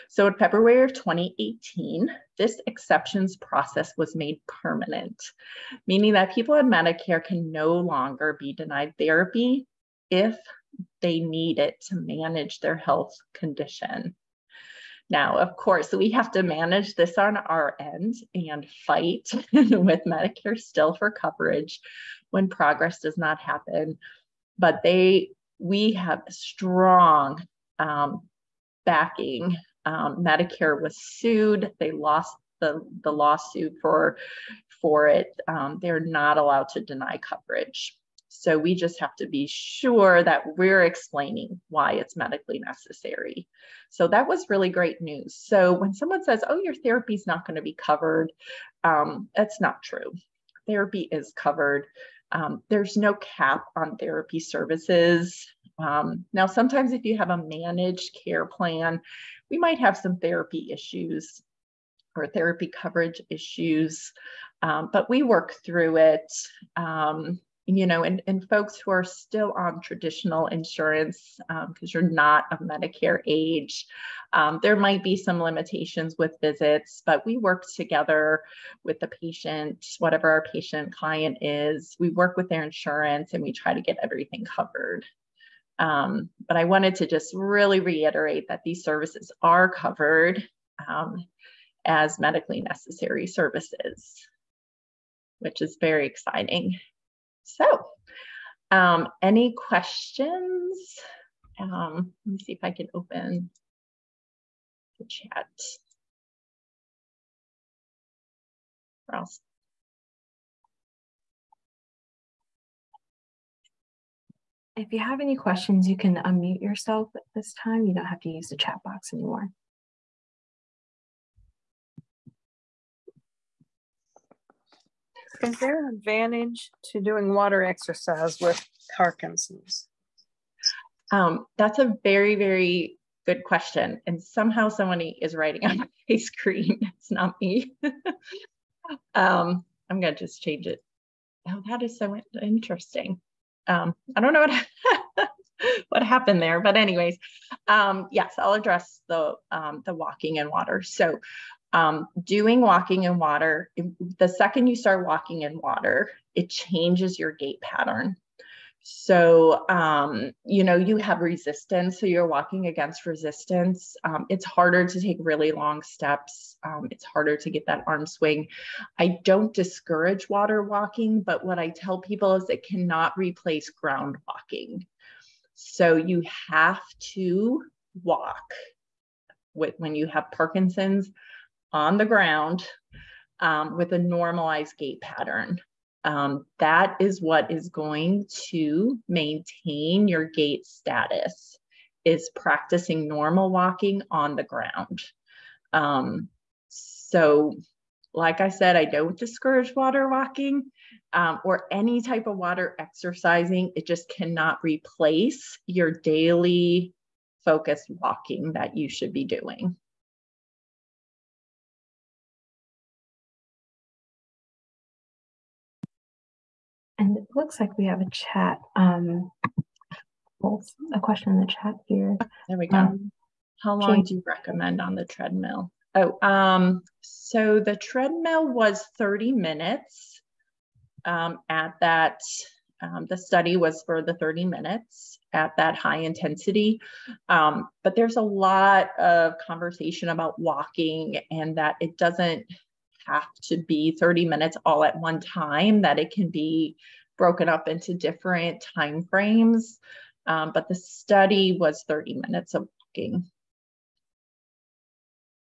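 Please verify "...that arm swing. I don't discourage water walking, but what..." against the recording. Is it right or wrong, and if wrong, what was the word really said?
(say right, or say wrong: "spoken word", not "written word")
right.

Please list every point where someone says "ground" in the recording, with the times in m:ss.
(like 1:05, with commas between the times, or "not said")
2:53, 3:02, 3:14.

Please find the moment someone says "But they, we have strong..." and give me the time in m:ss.
0:24.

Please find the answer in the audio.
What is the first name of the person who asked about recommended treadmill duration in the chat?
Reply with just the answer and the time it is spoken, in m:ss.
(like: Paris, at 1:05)
Jane, at 3:43.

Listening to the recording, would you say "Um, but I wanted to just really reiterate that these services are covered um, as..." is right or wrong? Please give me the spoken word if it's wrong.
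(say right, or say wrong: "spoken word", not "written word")
right.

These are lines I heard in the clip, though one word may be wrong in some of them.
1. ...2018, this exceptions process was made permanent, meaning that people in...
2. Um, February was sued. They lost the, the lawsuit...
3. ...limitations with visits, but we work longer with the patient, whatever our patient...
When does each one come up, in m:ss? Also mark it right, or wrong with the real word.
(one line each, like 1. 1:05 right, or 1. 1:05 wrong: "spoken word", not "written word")
1. 0:00 right
2. 0:29 wrong: "Medicare", not "February"
3. 1:15 wrong: "together", not "longer".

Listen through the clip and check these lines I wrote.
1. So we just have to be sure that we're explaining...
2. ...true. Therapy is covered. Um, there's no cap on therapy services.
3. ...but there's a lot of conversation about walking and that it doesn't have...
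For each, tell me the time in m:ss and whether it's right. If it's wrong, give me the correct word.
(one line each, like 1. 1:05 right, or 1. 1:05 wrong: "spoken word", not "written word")
1. 0:38 right
2. 0:49 right
3. 3:57 right.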